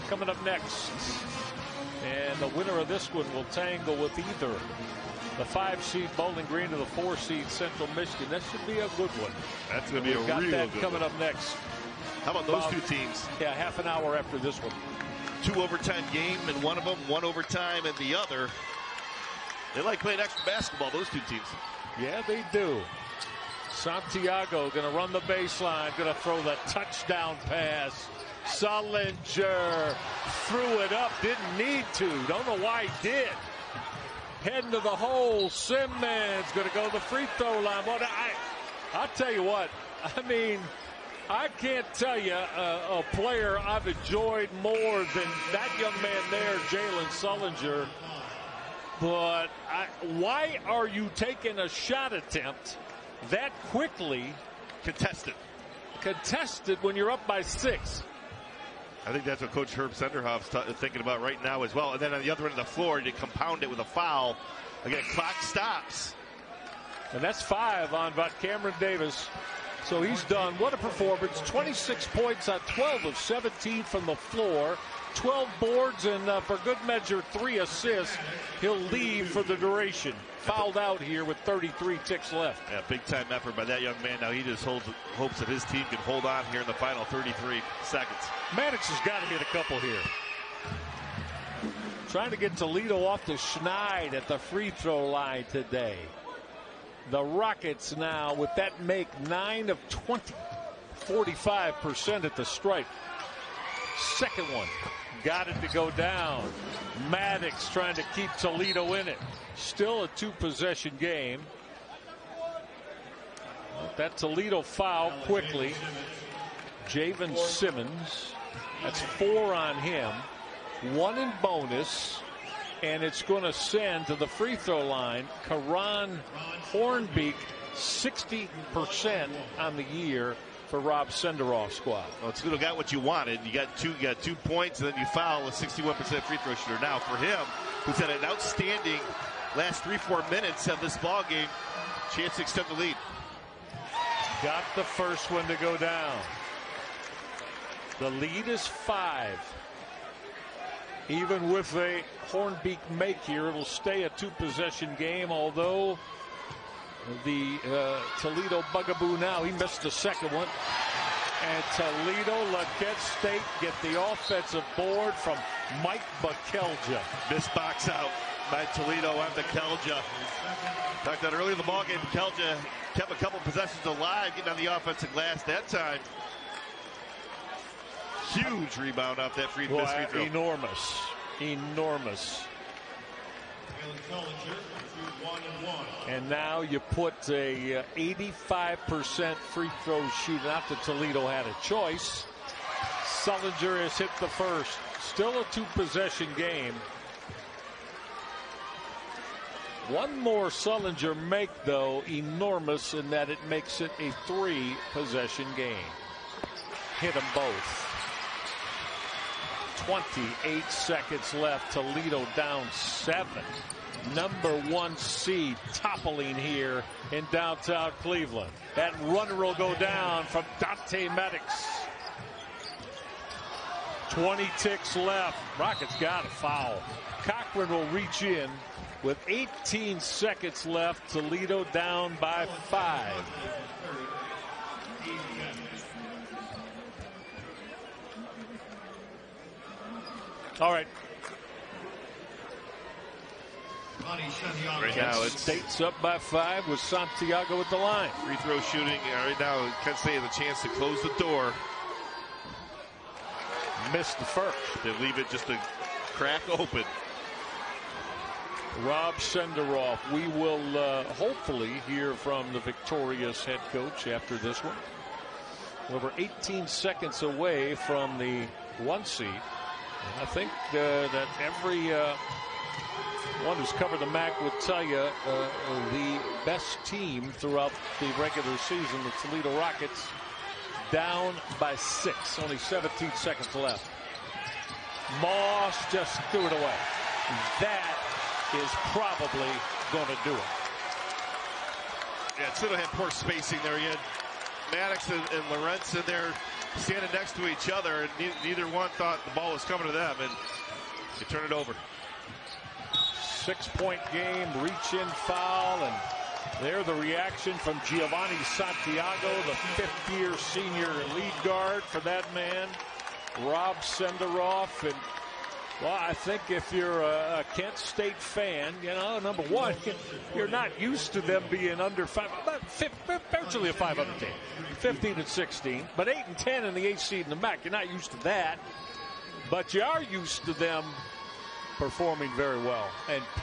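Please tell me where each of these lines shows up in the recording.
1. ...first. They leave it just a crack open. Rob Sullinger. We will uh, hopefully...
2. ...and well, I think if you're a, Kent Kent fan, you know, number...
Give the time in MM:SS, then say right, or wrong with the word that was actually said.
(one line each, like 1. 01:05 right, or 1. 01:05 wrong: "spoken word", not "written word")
1. 04:14 wrong: "Senderoff", not "Sullinger"
2. 05:14 wrong: "State", not "Kent".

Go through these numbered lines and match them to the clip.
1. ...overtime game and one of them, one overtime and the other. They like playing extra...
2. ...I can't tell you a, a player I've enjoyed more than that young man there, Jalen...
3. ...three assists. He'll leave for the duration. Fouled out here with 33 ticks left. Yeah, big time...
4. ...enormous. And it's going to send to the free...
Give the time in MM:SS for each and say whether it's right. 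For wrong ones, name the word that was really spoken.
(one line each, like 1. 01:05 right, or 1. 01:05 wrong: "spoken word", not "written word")
1. 00:15 right
2. 00:41 right
3. 01:17 right
4. 02:01 wrong: "bonus", not "enormous".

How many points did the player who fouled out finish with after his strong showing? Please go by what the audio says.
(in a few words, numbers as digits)
26.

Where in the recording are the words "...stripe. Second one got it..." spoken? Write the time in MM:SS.
01:42.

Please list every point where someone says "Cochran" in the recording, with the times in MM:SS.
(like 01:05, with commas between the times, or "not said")
03:47.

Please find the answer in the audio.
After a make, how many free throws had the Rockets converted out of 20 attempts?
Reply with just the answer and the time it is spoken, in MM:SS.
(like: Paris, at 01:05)
9, at 01:39.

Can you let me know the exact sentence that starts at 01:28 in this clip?
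Maddox has got to hit a couple here.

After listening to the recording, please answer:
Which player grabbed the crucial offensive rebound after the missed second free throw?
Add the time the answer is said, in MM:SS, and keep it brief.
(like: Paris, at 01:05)
Mike Bekelja, at 02:45.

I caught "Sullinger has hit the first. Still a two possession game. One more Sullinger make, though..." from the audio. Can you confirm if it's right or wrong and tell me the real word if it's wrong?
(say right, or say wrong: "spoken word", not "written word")
right.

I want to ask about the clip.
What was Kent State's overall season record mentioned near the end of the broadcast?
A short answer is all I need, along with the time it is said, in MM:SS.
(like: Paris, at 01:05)
15-16, at 05:24.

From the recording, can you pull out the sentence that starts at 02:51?
Talked that earlier in the ballgame, Kelja kept a couple possessions alive, getting on the offensive glass that time.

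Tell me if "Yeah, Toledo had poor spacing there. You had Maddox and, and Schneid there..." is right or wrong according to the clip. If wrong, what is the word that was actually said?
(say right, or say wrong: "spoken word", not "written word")
wrong: "Lorentzen", not "Schneid".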